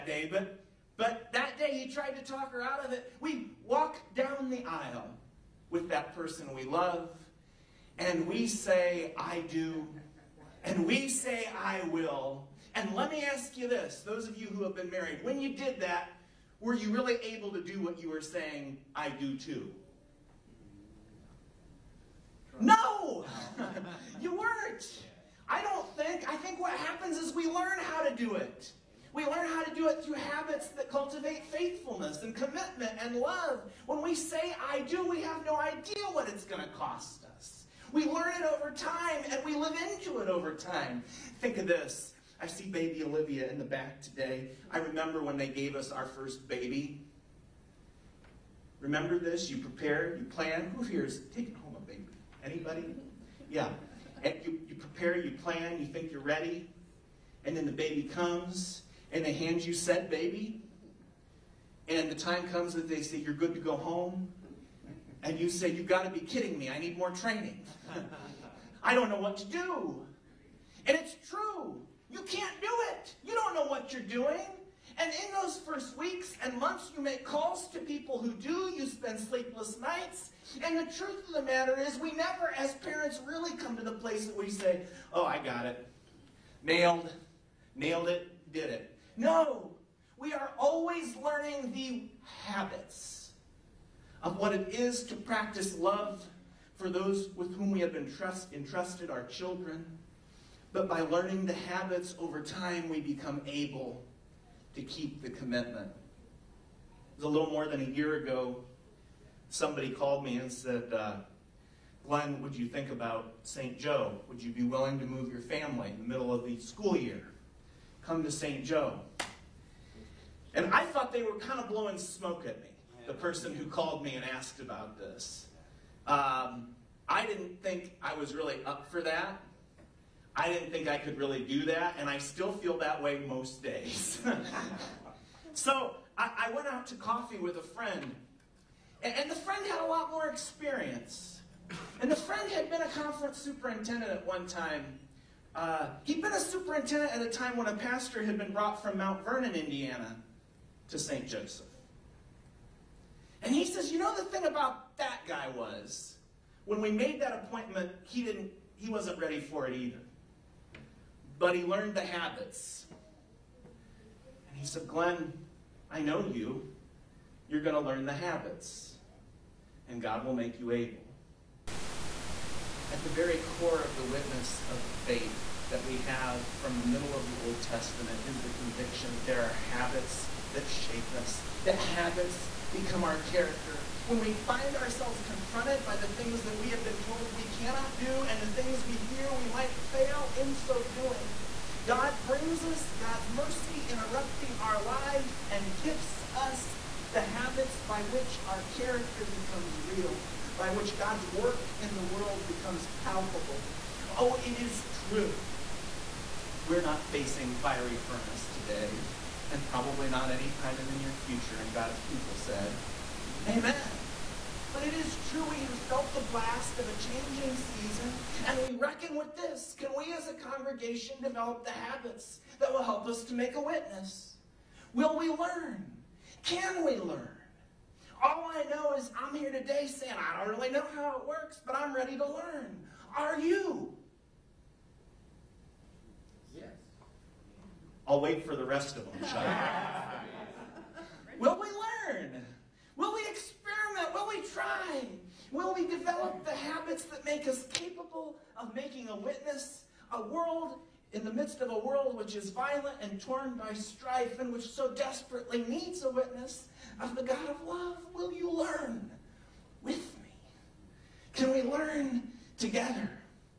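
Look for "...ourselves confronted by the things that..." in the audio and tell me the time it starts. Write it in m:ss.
3:04.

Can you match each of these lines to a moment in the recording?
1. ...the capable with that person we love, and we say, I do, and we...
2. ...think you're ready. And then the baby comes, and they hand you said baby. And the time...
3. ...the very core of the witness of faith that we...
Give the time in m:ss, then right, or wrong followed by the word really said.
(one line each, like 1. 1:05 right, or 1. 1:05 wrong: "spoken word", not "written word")
1. 0:04 wrong: "aisle", not "capable"
2. 0:55 right
3. 2:53 right.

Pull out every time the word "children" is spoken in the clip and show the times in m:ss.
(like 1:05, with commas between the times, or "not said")
1:39.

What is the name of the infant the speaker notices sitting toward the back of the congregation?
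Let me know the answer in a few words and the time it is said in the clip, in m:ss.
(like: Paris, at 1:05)
Olivia, at 0:43.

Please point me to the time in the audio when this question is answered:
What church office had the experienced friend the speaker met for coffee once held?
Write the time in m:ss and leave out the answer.
2:22.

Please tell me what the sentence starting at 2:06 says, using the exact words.
Um, I didn't think I was really up for that.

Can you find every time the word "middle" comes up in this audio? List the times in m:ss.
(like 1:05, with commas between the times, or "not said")
1:56, 2:56.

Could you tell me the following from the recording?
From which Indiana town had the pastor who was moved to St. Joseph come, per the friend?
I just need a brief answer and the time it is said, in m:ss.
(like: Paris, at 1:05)
Mount Vernon, at 2:28.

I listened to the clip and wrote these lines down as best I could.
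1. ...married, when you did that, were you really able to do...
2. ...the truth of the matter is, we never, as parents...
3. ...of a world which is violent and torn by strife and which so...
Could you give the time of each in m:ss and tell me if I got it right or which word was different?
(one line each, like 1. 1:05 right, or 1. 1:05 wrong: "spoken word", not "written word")
1. 0:14 right
2. 1:20 right
3. 4:11 right.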